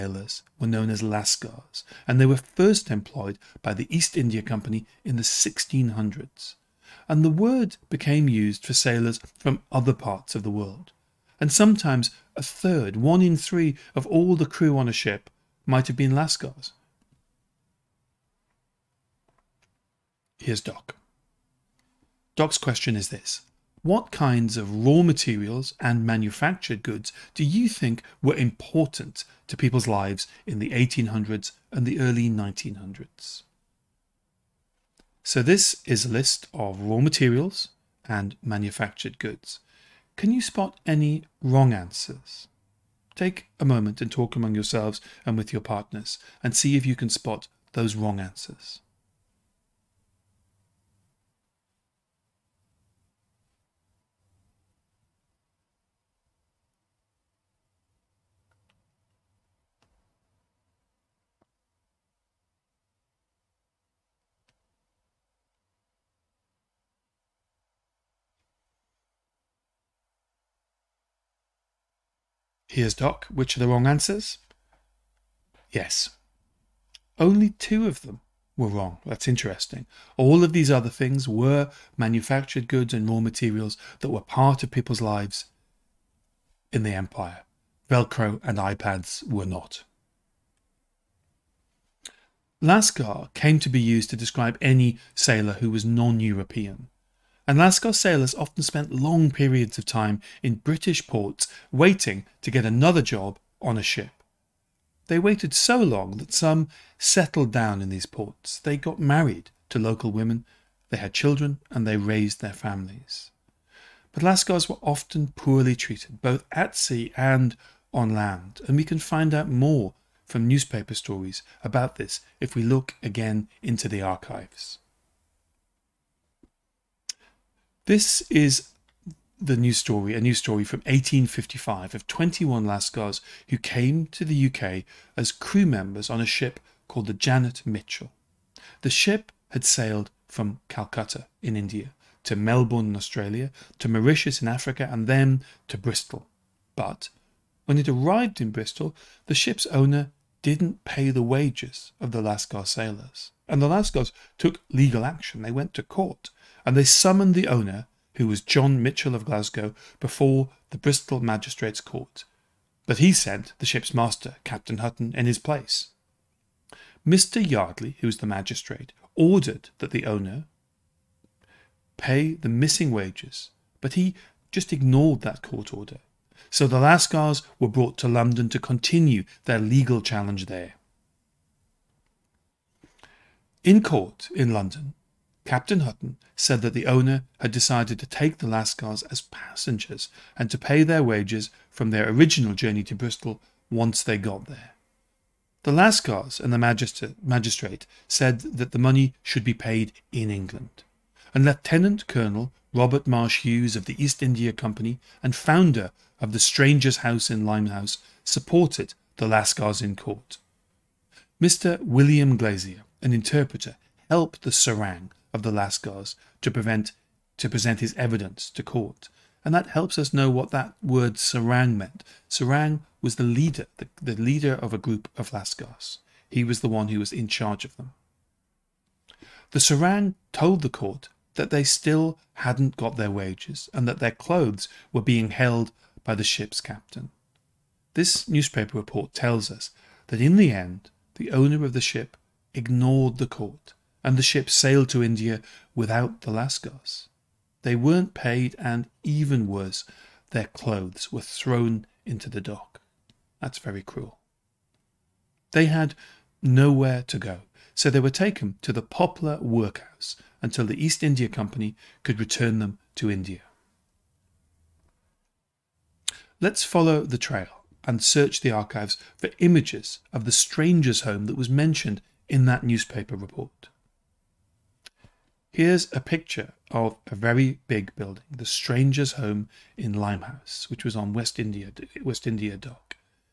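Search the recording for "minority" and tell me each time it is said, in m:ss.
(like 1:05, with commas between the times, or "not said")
not said.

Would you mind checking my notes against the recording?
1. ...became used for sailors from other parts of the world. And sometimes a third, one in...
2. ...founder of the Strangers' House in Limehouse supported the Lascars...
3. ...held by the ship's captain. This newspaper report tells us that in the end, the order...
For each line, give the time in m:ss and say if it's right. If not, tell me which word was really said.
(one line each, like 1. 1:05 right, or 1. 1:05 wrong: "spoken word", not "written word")
1. 0:07 right
2. 3:25 right
3. 3:55 wrong: "owner", not "order".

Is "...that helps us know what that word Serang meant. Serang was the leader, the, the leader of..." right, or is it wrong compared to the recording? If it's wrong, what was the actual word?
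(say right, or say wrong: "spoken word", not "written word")
right.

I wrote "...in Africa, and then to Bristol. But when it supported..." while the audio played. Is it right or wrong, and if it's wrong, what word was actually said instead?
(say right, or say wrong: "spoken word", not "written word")
wrong: "arrived", not "supported".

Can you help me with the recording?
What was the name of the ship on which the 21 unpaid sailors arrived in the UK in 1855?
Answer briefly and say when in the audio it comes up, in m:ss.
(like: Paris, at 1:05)
Janet Mitchell, at 2:17.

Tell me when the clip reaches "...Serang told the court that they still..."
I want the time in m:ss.
3:49.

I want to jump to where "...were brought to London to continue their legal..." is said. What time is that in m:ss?
2:57.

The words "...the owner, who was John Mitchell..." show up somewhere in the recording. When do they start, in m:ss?
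2:37.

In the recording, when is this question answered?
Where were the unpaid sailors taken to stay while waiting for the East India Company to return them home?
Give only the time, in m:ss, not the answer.
4:18.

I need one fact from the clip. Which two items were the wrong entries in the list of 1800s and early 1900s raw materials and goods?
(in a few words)
Velcro and iPads.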